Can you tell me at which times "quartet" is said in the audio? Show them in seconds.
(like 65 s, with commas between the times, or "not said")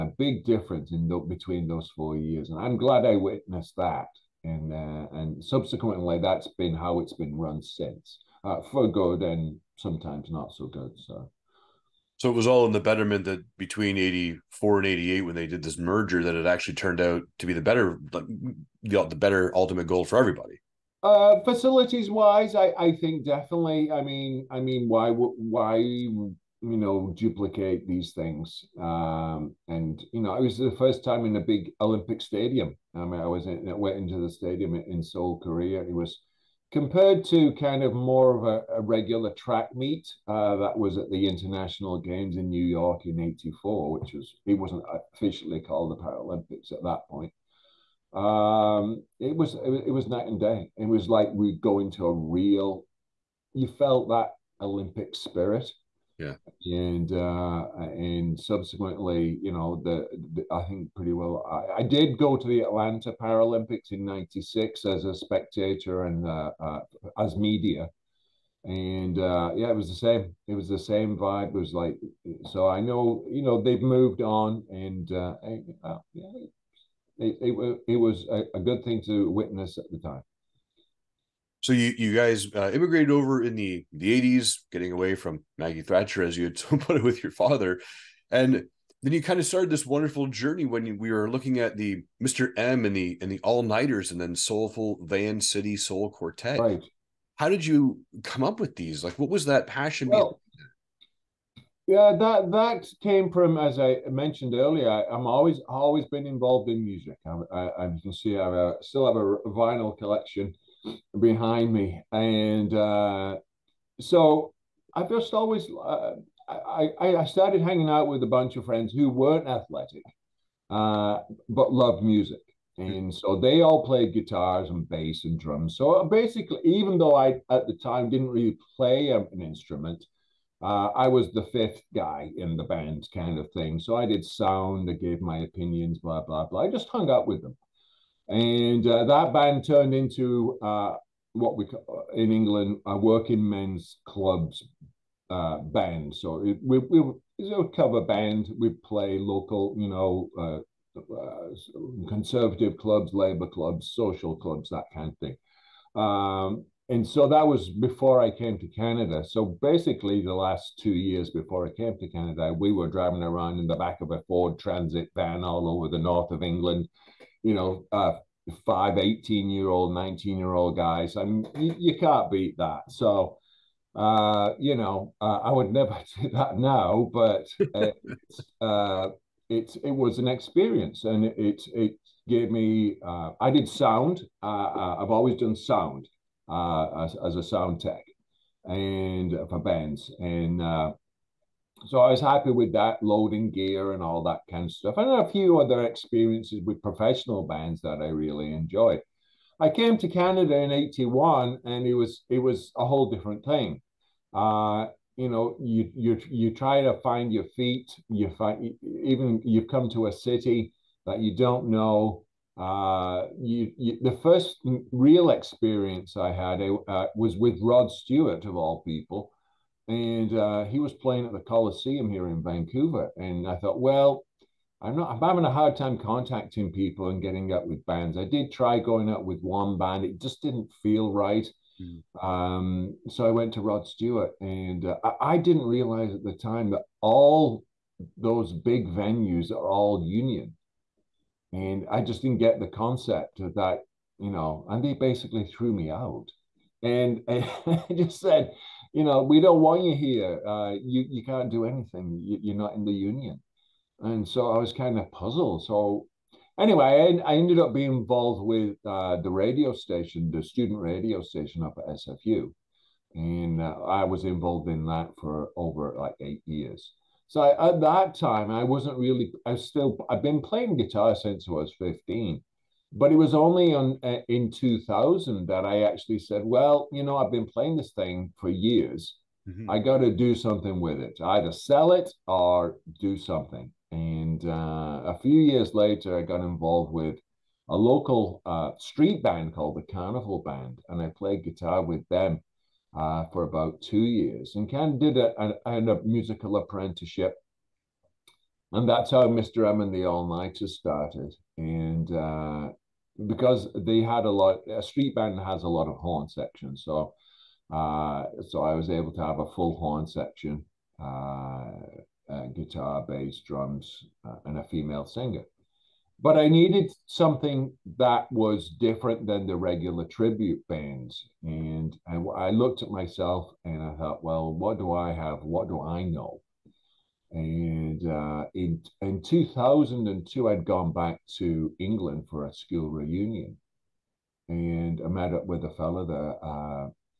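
96 s.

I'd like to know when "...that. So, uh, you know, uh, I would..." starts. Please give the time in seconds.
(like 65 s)
172 s.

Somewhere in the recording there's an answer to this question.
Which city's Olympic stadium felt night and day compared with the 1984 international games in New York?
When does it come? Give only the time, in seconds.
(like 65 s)
35 s.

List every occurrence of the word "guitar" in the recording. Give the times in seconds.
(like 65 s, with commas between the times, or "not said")
124 s, 270 s, 291 s, 312 s.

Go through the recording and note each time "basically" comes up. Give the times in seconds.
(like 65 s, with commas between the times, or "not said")
126 s, 159 s, 244 s.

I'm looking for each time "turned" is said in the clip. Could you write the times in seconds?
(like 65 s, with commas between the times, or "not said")
16 s, 139 s.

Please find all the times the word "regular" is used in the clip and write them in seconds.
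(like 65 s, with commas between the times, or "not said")
38 s, 319 s.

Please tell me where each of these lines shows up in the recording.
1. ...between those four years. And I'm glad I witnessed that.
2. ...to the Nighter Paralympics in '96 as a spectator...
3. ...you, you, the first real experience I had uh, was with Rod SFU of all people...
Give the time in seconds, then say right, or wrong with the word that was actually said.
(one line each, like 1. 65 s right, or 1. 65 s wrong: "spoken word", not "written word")
1. 1 s right
2. 62 s wrong: "Atlanta", not "Nighter"
3. 213 s wrong: "Stewart", not "SFU".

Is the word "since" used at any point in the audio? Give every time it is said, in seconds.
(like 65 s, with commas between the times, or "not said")
7 s, 271 s.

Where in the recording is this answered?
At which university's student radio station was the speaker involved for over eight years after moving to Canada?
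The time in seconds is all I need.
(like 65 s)
261 s.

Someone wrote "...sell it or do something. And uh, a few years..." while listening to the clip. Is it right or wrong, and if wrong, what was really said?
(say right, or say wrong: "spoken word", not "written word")
right.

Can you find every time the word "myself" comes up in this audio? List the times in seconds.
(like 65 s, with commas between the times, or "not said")
322 s.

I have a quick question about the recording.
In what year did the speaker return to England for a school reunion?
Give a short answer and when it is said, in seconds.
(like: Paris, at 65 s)
2002, at 329 s.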